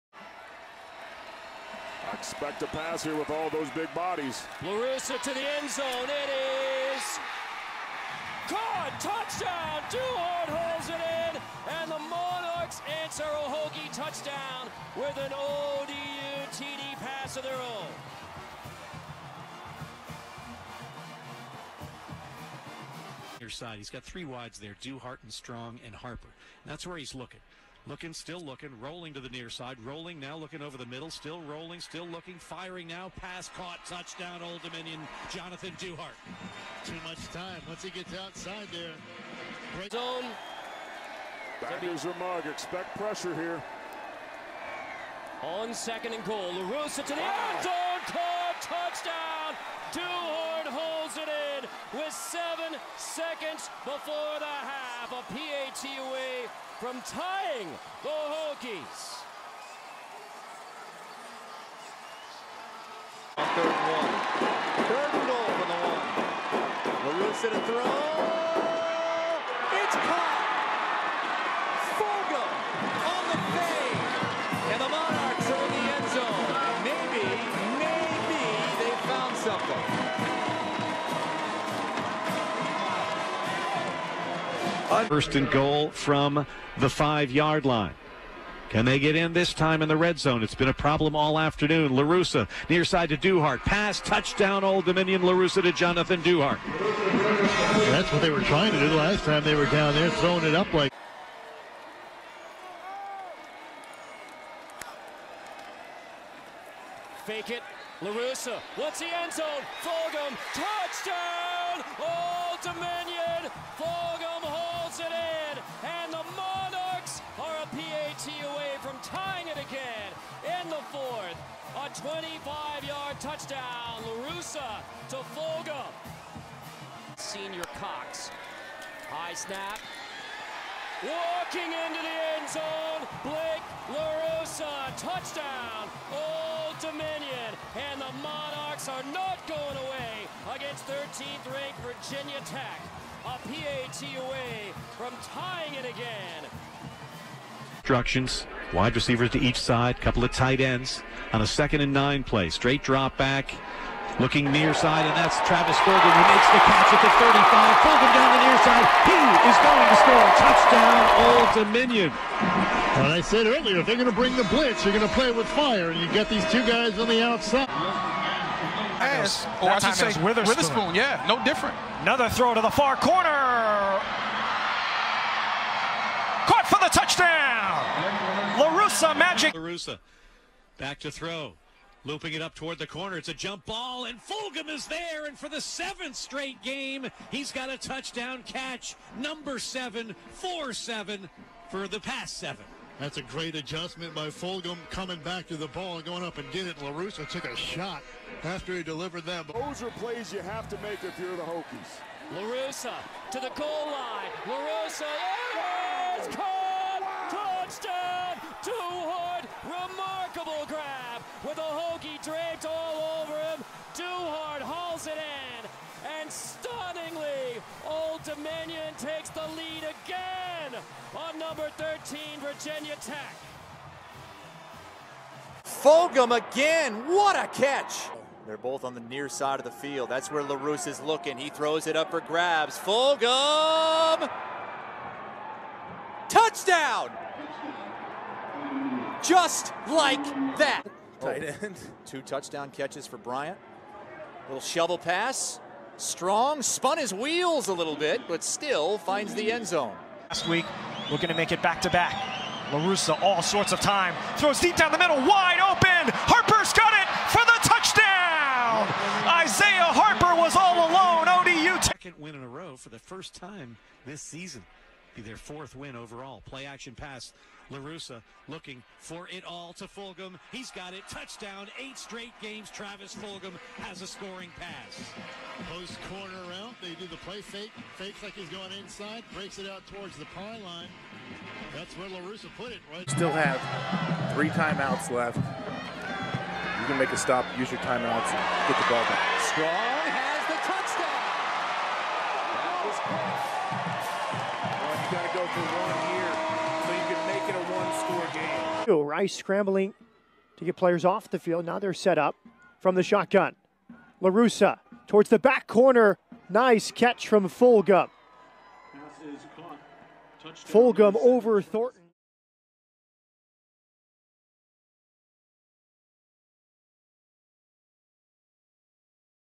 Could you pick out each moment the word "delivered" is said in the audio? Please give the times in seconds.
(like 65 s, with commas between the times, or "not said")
198 s.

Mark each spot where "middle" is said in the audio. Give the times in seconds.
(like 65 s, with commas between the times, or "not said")
30 s, 254 s.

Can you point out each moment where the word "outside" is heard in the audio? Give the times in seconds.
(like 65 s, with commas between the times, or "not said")
38 s, 167 s.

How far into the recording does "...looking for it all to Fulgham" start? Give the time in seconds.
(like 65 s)
268 s.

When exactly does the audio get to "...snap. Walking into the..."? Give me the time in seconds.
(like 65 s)
129 s.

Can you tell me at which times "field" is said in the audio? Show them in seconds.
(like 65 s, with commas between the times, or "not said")
229 s, 301 s.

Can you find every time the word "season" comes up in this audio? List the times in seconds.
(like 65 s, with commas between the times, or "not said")
264 s.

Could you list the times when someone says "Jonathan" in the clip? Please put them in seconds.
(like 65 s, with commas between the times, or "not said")
35 s, 95 s.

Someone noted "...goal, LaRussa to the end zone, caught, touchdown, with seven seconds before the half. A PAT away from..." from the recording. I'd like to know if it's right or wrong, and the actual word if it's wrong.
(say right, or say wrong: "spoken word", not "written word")
right.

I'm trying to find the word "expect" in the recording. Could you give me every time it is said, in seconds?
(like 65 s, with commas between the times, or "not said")
2 s, 42 s.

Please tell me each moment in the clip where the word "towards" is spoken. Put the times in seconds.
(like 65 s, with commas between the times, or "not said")
182 s, 279 s, 305 s.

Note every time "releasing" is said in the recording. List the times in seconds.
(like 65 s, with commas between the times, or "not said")
not said.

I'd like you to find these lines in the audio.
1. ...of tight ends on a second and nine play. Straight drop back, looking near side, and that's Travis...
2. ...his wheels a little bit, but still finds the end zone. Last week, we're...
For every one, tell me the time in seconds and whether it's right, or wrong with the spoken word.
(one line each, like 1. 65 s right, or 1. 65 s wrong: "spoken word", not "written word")
1. 150 s right
2. 246 s right.